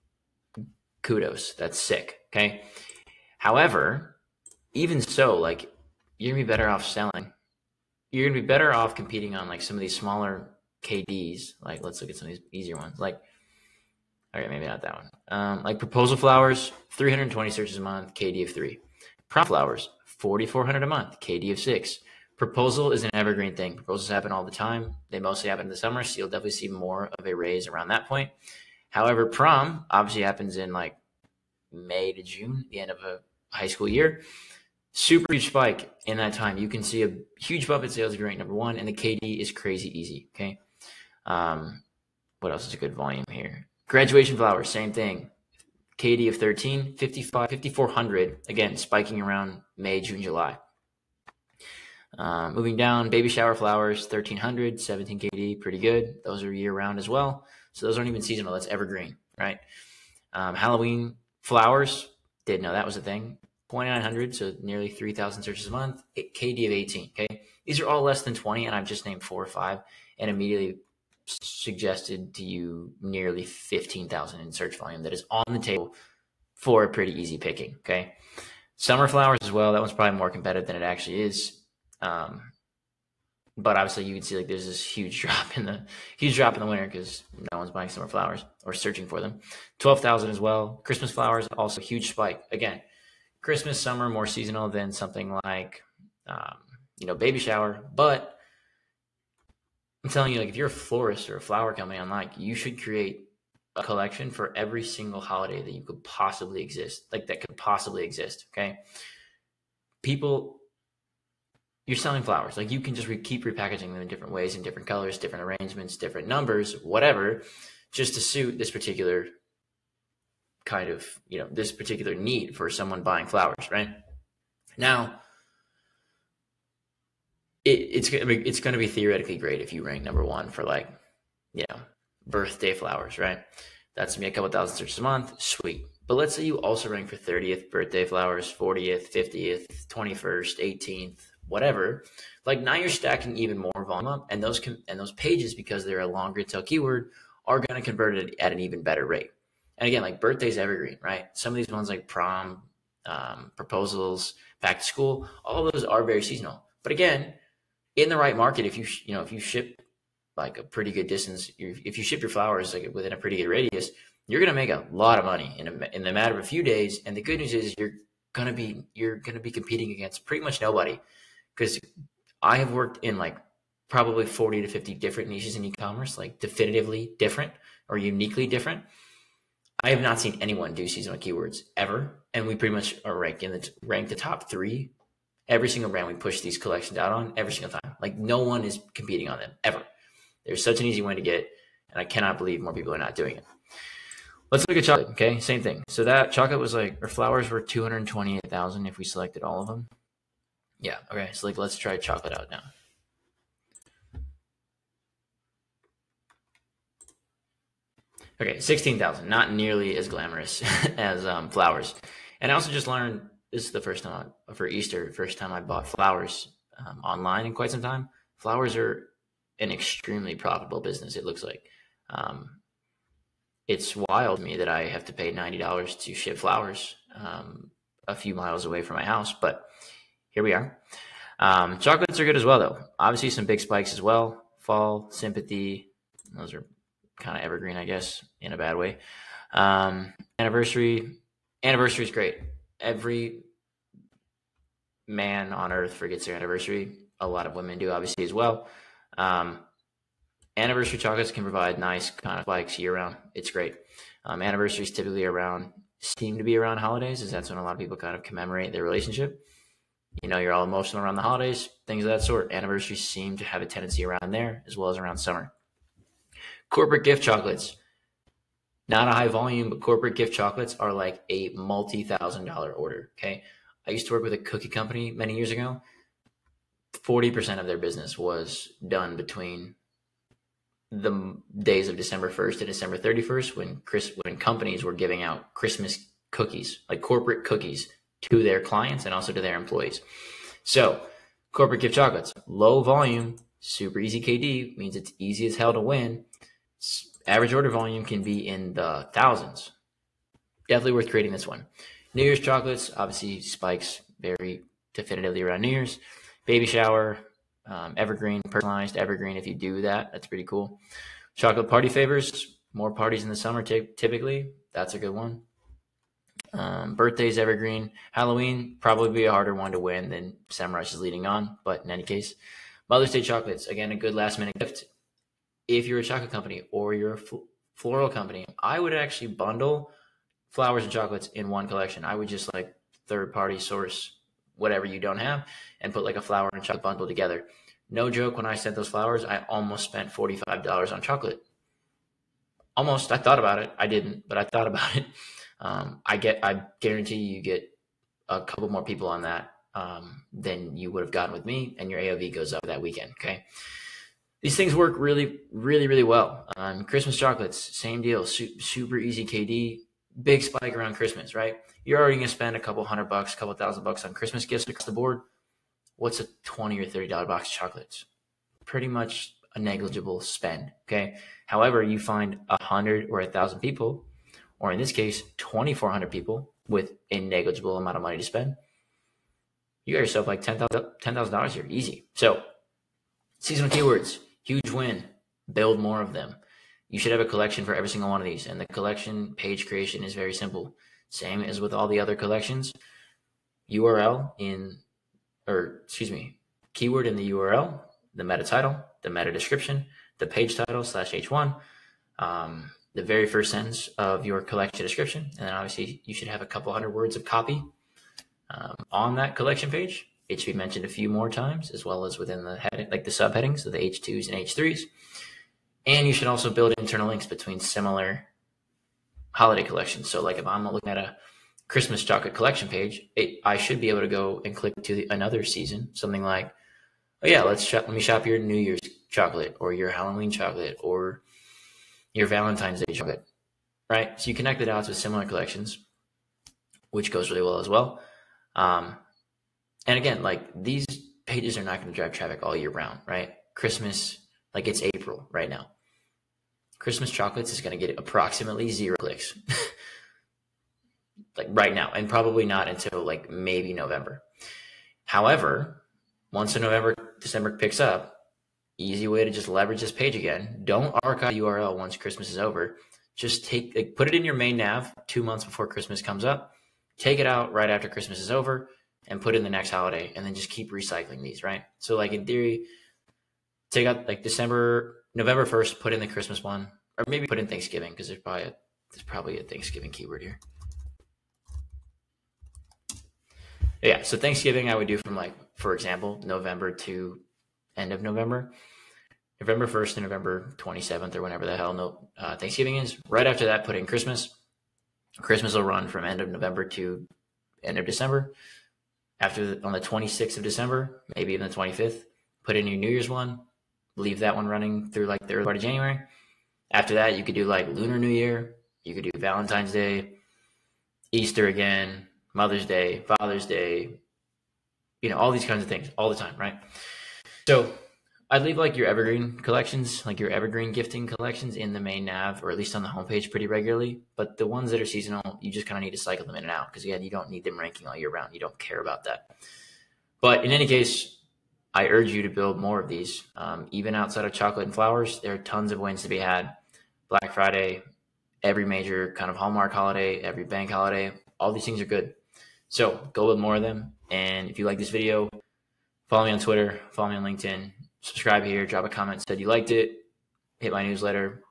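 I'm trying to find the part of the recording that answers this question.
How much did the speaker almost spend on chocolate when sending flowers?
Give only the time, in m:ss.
5:40.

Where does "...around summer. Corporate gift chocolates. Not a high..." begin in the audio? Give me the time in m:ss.
4:24.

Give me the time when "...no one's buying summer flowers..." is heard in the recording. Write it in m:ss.
1:27.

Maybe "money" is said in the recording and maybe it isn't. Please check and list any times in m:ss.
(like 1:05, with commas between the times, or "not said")
2:45, 6:18.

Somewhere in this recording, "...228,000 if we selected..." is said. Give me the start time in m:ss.
3:17.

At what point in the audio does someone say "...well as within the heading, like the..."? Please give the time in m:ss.
6:51.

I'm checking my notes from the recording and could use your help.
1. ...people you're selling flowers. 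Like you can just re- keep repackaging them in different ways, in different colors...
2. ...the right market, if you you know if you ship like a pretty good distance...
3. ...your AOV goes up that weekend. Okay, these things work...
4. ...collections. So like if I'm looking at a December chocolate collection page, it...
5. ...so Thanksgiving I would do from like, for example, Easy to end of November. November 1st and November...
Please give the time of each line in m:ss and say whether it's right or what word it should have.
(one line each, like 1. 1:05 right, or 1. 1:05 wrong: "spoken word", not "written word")
1. 1:50 right
2. 2:38 right
3. 5:51 right
4. 6:59 wrong: "Christmas", not "December"
5. 8:04 wrong: "November", not "Easy".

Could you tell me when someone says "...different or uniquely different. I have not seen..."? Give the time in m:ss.
2:57.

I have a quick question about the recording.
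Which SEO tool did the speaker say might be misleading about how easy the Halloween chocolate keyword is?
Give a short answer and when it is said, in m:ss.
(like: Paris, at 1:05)
SEMrush, at 5:20.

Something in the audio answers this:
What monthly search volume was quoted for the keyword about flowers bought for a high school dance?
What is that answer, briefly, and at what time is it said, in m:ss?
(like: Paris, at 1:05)
4,400, at 0:20.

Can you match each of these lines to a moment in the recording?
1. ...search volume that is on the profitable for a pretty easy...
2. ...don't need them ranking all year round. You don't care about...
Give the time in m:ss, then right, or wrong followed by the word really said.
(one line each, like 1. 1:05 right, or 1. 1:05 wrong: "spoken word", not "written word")
1. 1:14 wrong: "table", not "profitable"
2. 8:47 right.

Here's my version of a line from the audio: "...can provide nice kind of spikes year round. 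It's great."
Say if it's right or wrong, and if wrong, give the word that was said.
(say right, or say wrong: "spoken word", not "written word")
right.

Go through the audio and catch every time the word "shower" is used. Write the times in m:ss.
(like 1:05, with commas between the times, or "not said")
0:53, 1:37, 5:06.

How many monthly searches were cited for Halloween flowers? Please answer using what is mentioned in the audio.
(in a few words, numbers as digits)
2900.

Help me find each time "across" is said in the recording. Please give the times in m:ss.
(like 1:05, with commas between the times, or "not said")
6:04.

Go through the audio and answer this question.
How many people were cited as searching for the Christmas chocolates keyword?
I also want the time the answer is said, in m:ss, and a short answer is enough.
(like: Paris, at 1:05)
2,400, at 6:15.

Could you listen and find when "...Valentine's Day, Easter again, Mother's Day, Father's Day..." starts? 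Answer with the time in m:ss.
8:29.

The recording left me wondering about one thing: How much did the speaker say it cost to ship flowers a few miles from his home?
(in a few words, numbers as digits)
$90.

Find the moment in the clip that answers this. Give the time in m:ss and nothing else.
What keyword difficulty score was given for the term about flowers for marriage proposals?
0:18.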